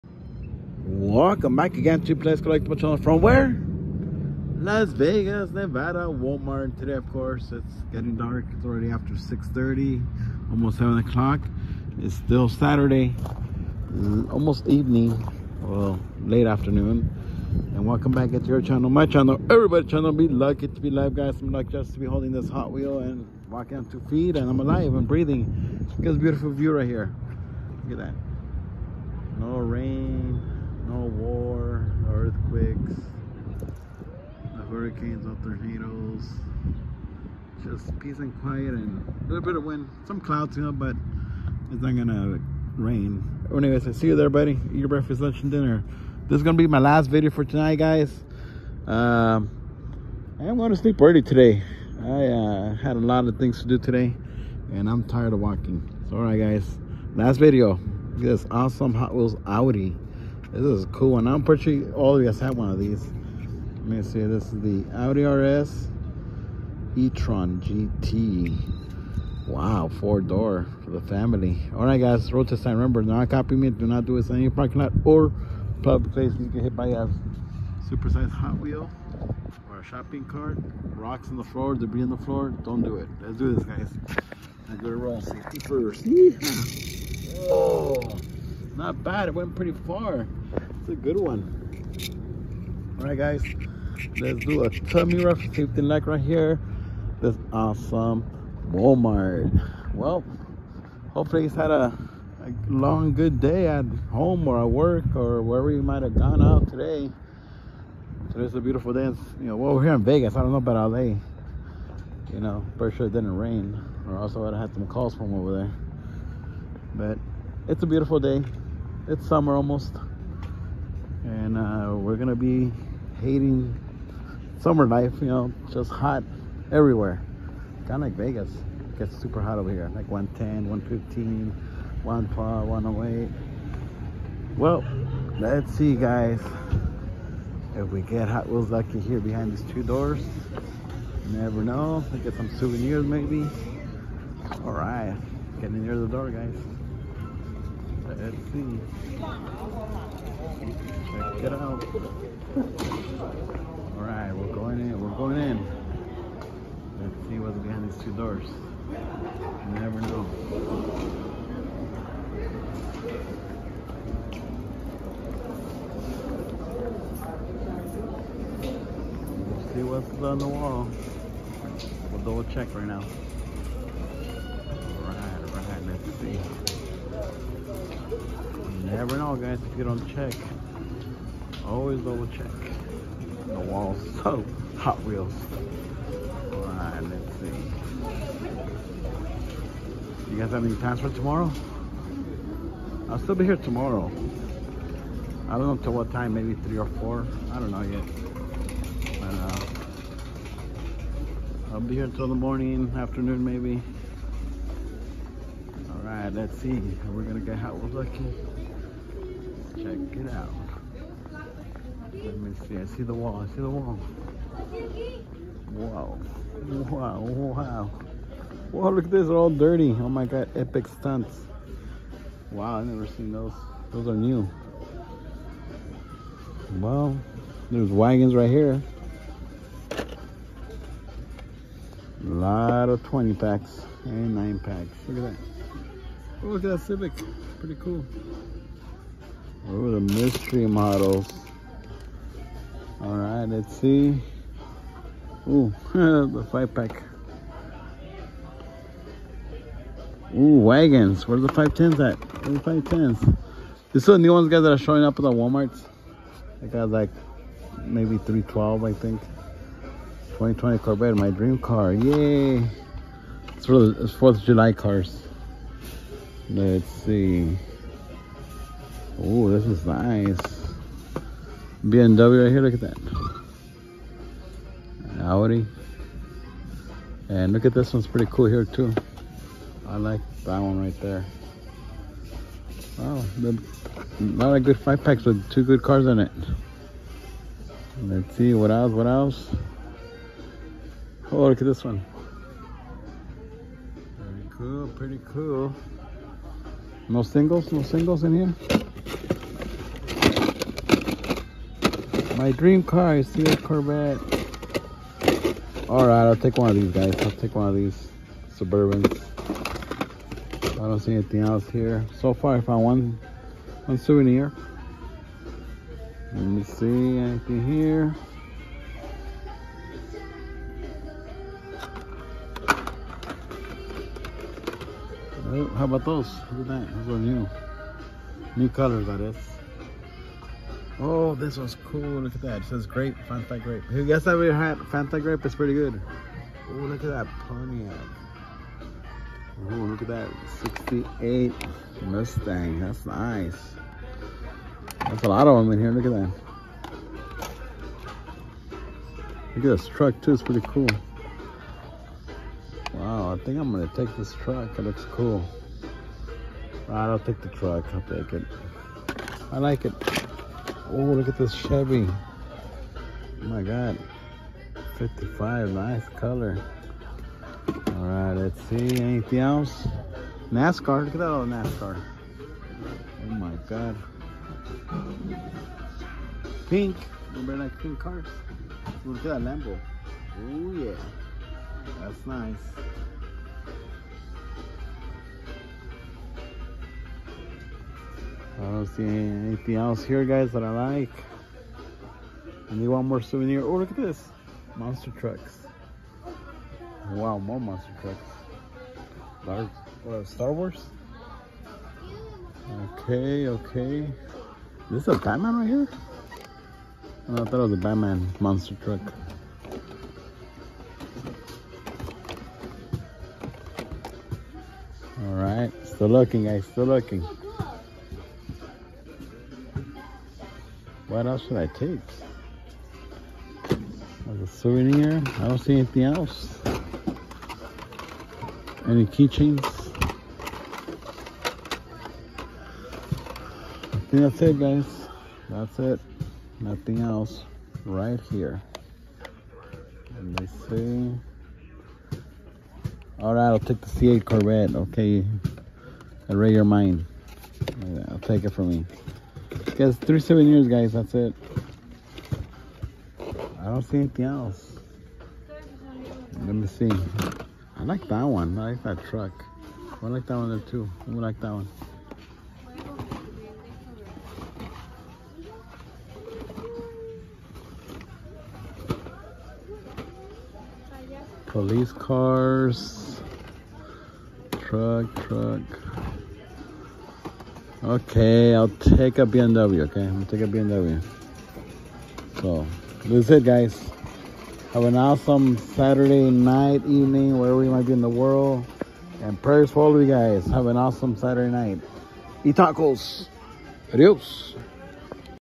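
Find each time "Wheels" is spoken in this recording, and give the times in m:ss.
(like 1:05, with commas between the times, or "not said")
0:22, 0:59, 1:18, 2:18, 3:05.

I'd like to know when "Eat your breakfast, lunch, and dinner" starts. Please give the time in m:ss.
0:44.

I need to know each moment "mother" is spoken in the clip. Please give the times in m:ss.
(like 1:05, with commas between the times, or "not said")
not said.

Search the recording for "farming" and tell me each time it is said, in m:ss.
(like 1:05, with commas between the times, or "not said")
not said.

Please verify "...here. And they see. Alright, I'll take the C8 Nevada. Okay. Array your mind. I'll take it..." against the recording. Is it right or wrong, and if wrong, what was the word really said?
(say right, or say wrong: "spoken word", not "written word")
wrong: "Corvette", not "Nevada".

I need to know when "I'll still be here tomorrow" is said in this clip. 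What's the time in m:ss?
3:13.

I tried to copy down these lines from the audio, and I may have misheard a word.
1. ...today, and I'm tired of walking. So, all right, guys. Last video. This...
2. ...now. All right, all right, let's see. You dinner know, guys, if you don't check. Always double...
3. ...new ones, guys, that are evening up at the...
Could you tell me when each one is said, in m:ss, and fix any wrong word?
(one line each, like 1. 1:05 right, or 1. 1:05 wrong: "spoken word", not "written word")
1. 0:53 right
2. 2:52 wrong: "never", not "dinner"
3. 4:14 wrong: "showing", not "evening".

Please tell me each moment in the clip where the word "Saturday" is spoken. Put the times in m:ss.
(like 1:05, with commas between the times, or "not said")
0:12, 8:05, 8:11.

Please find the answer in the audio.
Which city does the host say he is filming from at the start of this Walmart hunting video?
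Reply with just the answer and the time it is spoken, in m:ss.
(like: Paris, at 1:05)
Las Vegas, at 0:04.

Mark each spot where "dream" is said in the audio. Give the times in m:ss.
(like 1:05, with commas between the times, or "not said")
4:21, 5:02.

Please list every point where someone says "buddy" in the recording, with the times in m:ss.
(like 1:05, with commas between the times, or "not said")
0:44.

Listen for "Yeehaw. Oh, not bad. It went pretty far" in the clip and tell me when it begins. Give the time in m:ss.
1:26.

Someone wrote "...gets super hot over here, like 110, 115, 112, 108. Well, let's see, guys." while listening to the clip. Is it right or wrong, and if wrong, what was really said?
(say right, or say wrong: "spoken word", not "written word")
right.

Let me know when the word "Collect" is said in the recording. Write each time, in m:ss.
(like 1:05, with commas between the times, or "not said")
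0:02.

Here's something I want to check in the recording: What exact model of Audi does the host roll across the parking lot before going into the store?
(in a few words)
Audi RS e-tron GT.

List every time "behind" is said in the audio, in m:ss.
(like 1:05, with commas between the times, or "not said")
2:19, 2:37.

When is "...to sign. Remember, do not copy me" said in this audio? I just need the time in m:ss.
1:12.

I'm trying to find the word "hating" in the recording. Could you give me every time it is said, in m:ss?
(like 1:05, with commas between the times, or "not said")
2:03.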